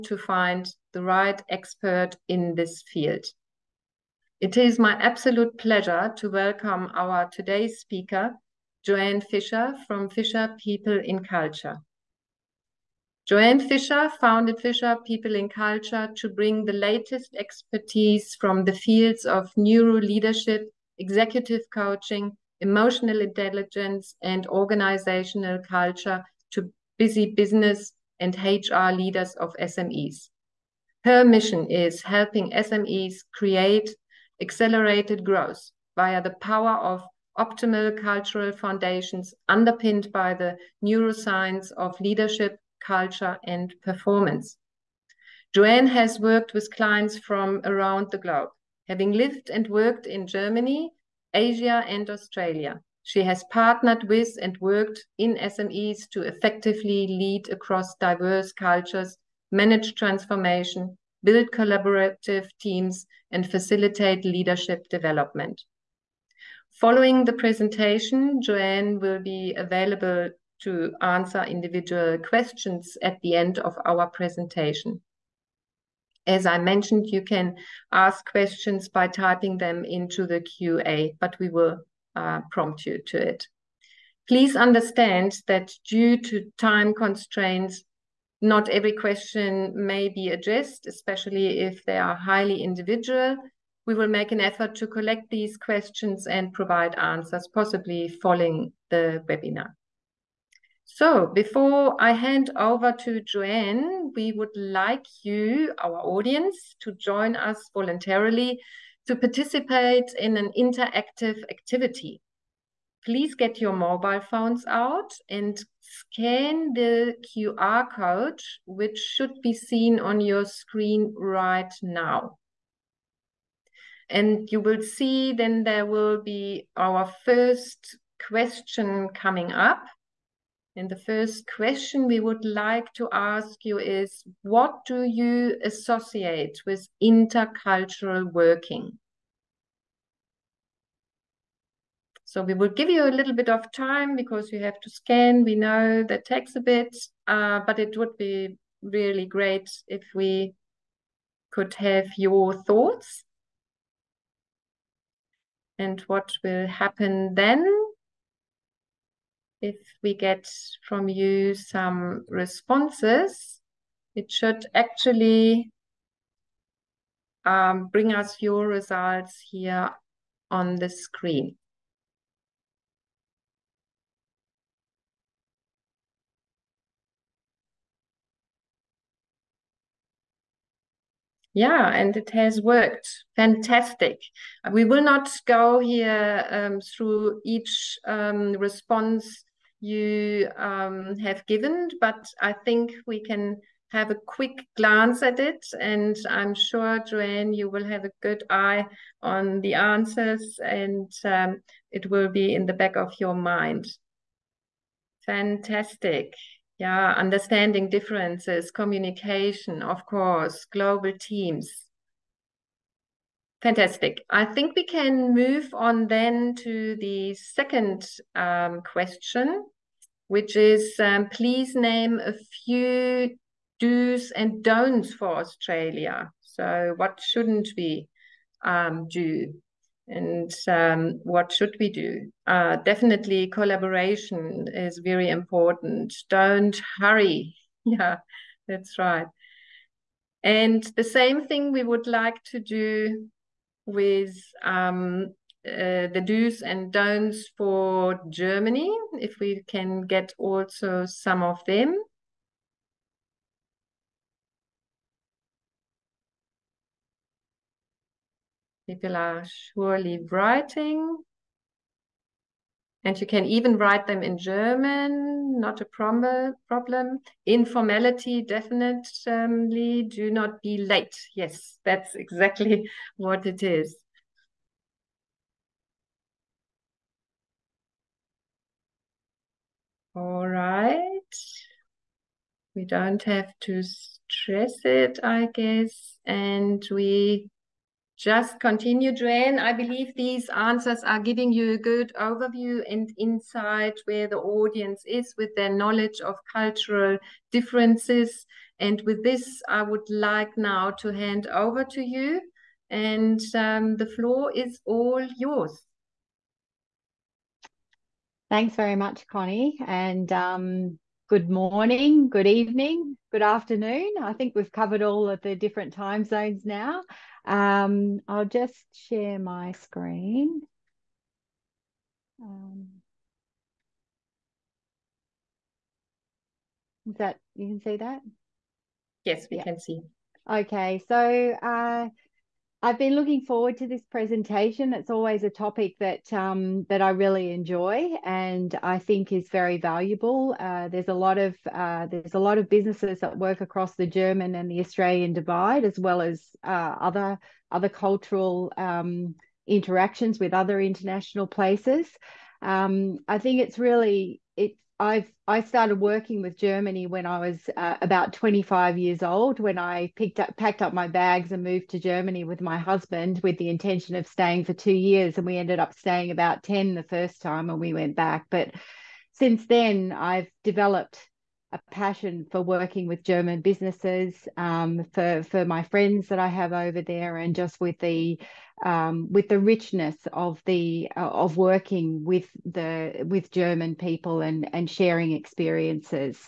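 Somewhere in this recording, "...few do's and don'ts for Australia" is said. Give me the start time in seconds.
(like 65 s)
222 s.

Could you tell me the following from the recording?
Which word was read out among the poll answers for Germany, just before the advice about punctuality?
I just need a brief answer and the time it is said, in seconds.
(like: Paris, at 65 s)
Informality, at 267 s.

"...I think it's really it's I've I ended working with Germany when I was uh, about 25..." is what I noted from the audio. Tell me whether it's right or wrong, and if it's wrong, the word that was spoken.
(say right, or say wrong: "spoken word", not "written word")
wrong: "started", not "ended".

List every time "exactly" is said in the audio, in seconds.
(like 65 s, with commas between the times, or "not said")
272 s.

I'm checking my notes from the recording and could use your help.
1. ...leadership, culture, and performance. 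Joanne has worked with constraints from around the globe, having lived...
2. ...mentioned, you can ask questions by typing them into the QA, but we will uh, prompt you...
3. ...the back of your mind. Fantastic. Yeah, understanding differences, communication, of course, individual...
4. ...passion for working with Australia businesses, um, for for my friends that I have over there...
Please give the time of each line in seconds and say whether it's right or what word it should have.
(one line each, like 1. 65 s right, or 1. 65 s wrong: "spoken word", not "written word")
1. 41 s wrong: "clients", not "constraints"
2. 76 s right
3. 202 s wrong: "global", not "individual"
4. 371 s wrong: "German", not "Australia".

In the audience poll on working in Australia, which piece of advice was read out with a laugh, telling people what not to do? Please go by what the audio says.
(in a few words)
Don't hurry.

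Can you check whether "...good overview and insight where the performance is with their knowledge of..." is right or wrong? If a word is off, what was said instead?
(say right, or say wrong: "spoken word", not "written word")
wrong: "audience", not "performance".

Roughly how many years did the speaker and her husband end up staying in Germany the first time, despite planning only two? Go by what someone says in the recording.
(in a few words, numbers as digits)
10.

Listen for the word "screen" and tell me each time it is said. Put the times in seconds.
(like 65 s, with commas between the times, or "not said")
120 s, 170 s, 319 s.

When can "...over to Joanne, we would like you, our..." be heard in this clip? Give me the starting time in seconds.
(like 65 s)
102 s.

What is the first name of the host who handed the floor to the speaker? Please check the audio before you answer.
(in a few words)
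Connie.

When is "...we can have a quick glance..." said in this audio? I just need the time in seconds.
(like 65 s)
193 s.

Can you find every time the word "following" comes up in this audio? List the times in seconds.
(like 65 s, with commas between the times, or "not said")
66 s, 98 s.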